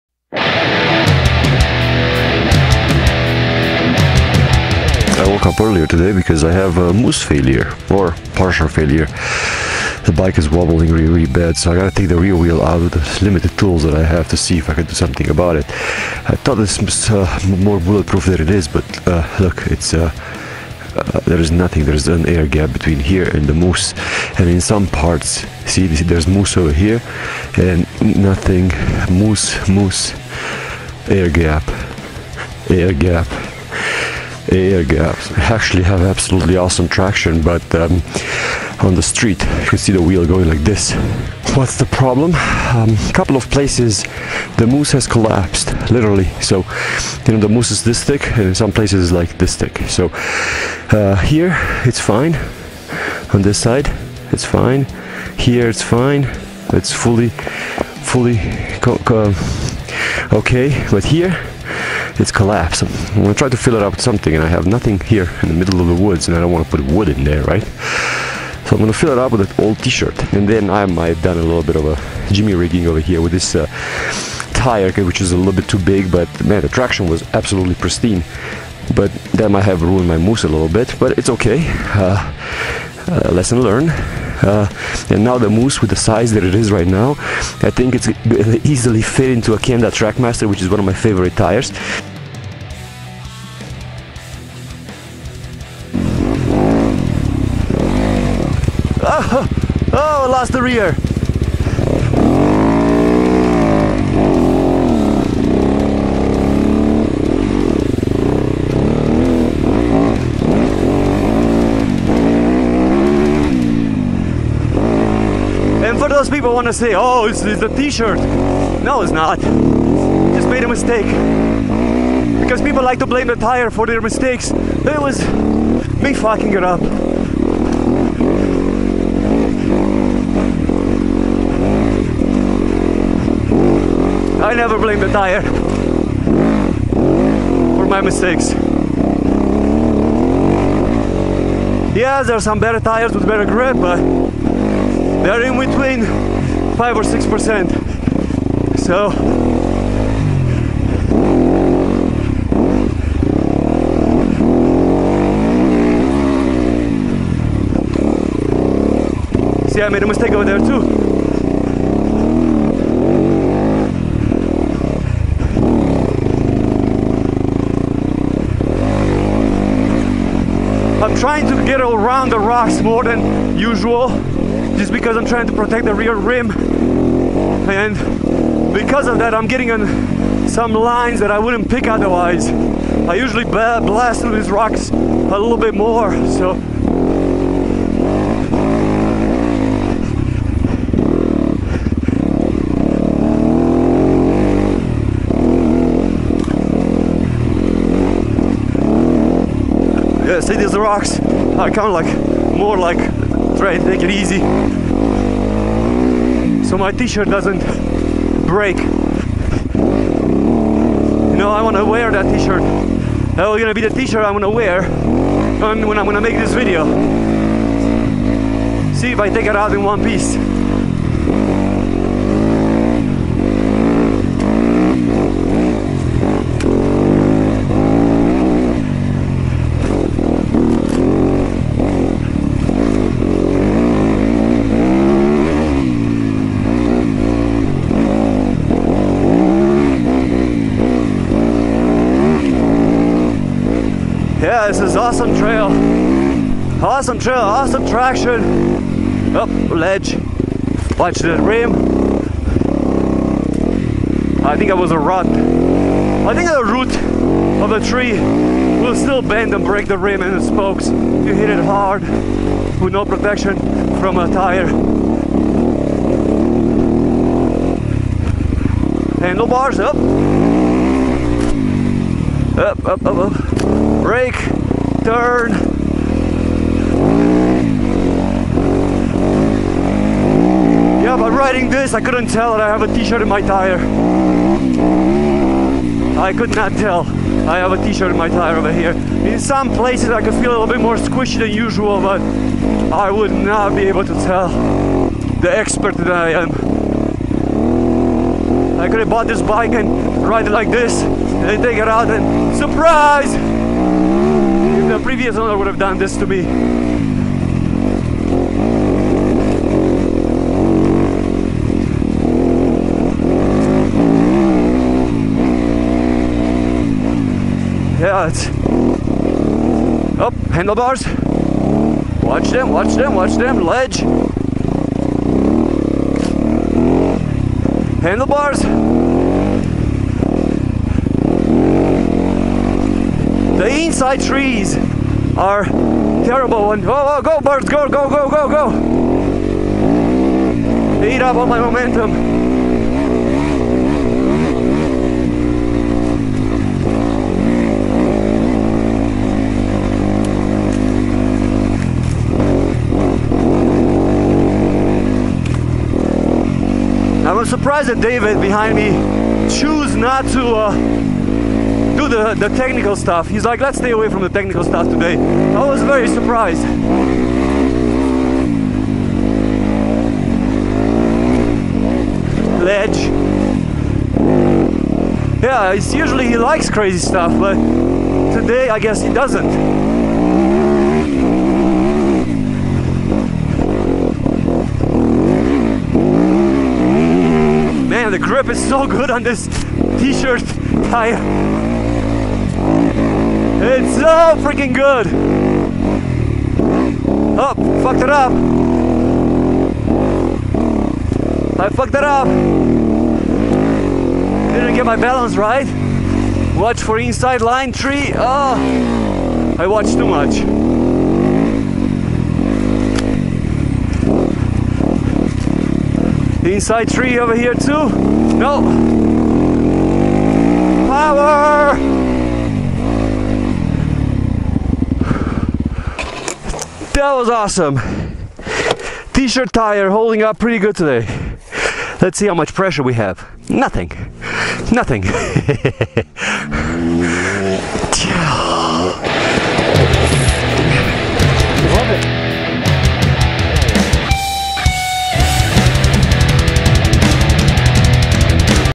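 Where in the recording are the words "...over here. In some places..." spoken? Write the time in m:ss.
4:48.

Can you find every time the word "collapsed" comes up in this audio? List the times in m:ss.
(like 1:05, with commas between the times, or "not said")
0:45, 1:02.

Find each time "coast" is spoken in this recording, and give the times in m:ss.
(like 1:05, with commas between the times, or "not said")
not said.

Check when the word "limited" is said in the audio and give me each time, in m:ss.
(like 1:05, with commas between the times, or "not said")
0:13.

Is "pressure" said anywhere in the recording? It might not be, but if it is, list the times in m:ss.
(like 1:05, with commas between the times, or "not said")
7:12.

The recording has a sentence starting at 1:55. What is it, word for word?
And for those people want to say, oh, it's, it's a t-shirt.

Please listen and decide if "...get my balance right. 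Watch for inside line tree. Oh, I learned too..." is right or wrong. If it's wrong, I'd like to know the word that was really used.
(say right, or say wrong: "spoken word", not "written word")
wrong: "watched", not "learned".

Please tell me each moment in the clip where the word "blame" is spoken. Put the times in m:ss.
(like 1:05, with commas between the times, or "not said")
2:03, 2:14.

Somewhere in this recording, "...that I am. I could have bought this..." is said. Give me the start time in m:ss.
4:55.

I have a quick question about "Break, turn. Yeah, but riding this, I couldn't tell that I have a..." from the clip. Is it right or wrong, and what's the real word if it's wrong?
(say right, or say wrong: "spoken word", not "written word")
right.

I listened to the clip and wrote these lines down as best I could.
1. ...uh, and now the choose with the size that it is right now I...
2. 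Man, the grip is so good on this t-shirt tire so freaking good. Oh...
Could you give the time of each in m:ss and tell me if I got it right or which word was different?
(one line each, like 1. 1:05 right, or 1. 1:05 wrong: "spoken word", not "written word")
1. 1:24 wrong: "mousse", not "choose"
2. 6:27 right.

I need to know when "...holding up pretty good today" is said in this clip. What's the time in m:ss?
7:09.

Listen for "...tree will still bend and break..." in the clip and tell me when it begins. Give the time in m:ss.
4:17.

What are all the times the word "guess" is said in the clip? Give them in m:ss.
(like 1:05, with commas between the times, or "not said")
6:18.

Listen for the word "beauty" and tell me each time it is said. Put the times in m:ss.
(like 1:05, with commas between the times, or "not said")
not said.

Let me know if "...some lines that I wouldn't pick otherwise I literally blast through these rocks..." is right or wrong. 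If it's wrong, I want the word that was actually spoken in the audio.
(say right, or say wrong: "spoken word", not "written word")
wrong: "usually", not "literally".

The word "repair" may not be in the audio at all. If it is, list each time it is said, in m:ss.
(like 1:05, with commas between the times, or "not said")
not said.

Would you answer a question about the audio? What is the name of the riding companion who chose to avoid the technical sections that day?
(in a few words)
David.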